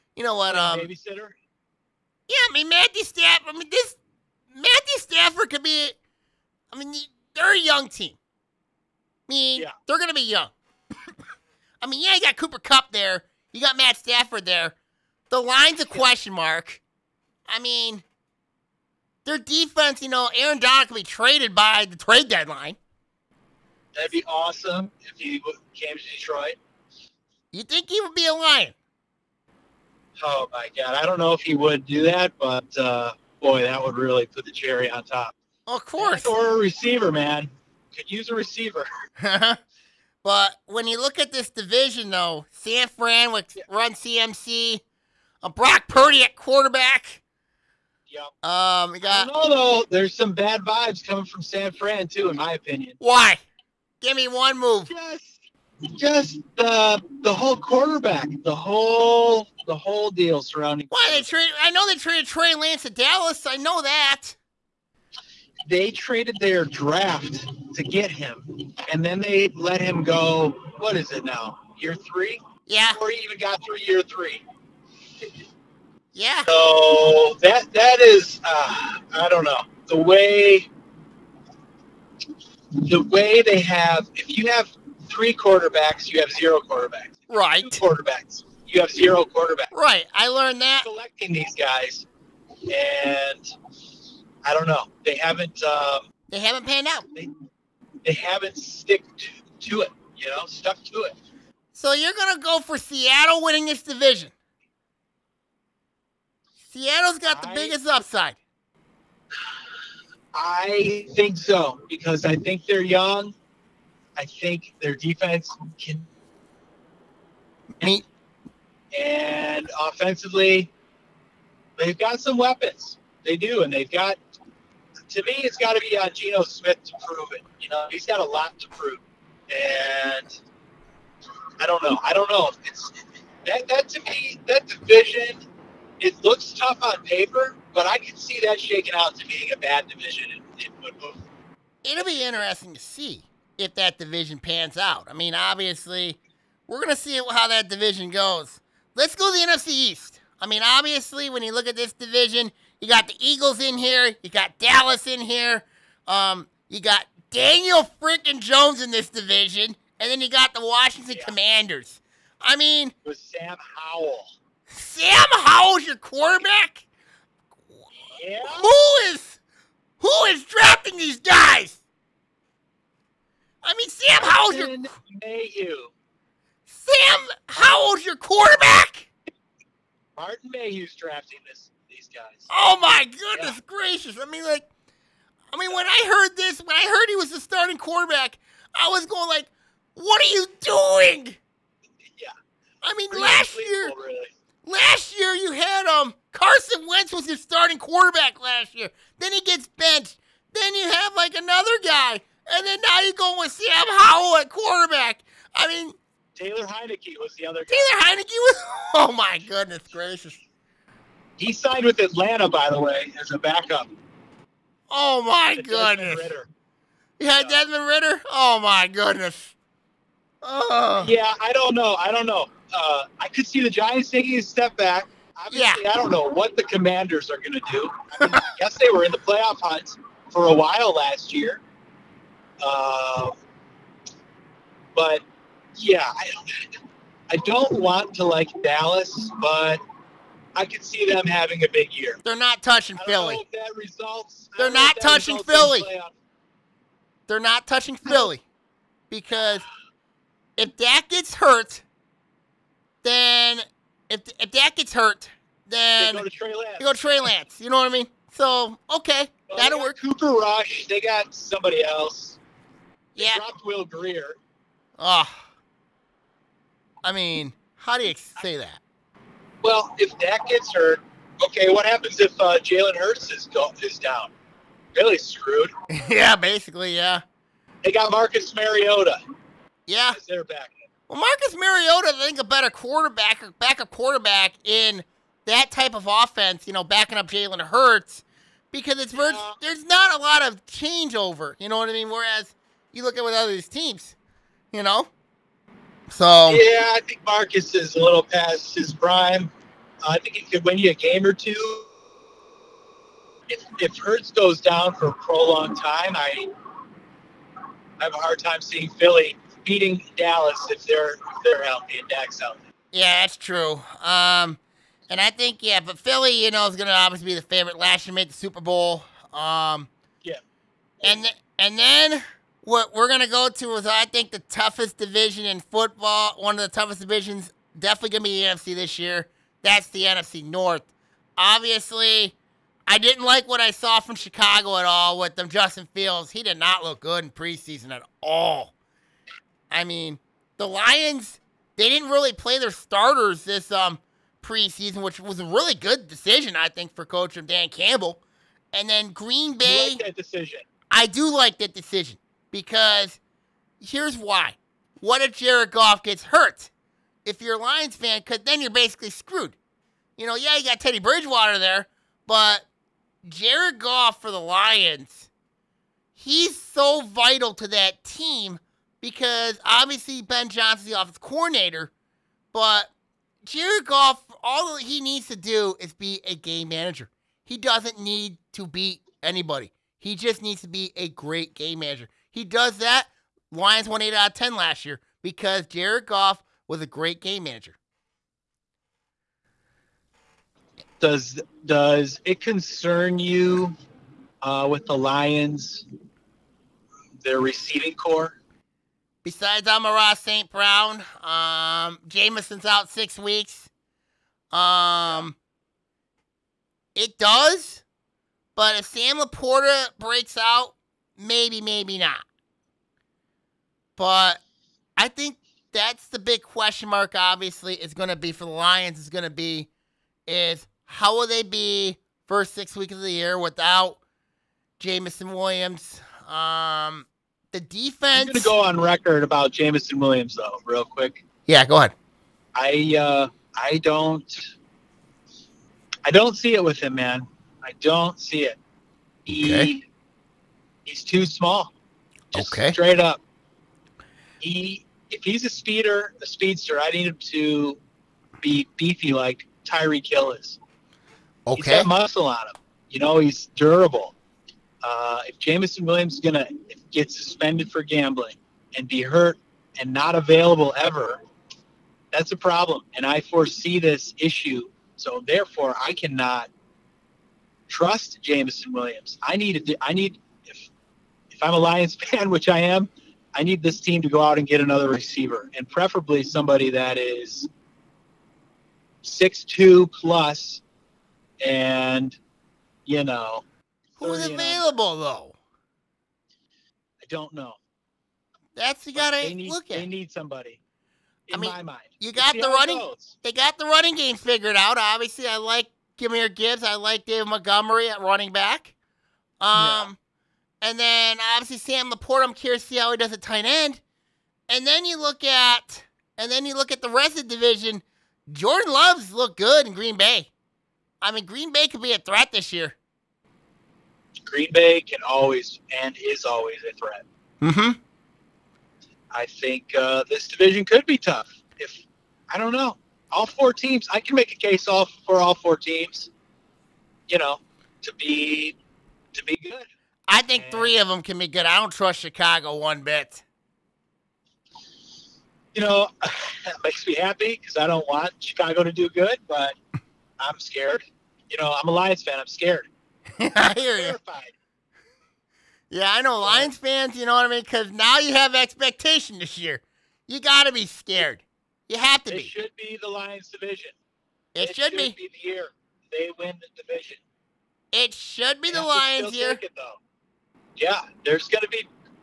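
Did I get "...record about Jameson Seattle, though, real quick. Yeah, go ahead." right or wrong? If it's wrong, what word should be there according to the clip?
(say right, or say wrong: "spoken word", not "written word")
wrong: "Williams", not "Seattle".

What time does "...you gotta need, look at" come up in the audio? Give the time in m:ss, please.
8:08.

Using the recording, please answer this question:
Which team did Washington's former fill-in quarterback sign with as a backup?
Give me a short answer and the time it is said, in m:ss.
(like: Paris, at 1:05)
Atlanta, at 3:31.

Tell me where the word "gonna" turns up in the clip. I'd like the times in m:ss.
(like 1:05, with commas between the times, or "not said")
1:42, 2:26, 7:36.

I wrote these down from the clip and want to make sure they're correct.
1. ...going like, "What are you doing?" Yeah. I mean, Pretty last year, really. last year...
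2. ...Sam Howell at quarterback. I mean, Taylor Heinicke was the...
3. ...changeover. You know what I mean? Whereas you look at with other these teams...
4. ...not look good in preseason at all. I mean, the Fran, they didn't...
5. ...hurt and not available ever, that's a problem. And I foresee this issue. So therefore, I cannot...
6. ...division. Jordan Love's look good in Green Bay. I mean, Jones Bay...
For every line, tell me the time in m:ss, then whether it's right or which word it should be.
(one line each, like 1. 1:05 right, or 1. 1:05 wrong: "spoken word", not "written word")
1. 3:09 right
2. 3:23 right
3. 4:50 right
4. 5:36 wrong: "Lions", not "Fran"
5. 7:39 right
6. 8:27 wrong: "Green", not "Jones".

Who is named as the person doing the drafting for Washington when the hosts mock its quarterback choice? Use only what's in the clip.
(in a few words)
Martin Mayhew.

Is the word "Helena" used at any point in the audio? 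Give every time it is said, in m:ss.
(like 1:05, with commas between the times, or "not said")
not said.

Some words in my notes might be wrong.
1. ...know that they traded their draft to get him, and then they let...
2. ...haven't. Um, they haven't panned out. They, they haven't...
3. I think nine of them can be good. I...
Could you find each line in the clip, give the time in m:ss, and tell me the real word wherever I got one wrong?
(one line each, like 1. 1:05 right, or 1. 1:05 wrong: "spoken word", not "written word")
1. 1:03 right
2. 1:35 right
3. 8:50 wrong: "three", not "nine".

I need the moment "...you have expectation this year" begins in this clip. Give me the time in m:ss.
9:08.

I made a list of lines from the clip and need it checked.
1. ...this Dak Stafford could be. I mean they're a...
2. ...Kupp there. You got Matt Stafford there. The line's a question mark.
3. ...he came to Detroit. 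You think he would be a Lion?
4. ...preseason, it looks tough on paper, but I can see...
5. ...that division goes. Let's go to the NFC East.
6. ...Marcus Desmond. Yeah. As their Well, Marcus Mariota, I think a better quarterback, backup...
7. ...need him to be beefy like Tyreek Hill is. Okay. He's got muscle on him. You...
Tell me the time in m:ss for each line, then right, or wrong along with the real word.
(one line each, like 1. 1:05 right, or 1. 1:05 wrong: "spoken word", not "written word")
1. 0:03 wrong: "Matthew", not "Dak"
2. 0:12 right
3. 0:25 right
4. 2:14 wrong: "division", not "preseason"
5. 2:27 right
6. 4:38 wrong: "Mariota", not "Desmond"
7. 7:26 right.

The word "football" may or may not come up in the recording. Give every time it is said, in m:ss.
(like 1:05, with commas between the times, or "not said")
2:20, 5:25.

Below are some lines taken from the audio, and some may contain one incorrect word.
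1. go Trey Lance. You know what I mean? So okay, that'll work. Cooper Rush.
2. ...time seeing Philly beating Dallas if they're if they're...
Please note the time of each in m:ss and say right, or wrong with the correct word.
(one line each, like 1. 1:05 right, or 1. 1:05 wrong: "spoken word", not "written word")
1. 4:16 right
2. 5:08 right.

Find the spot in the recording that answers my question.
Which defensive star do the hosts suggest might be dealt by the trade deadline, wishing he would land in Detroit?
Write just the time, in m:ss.
0:20.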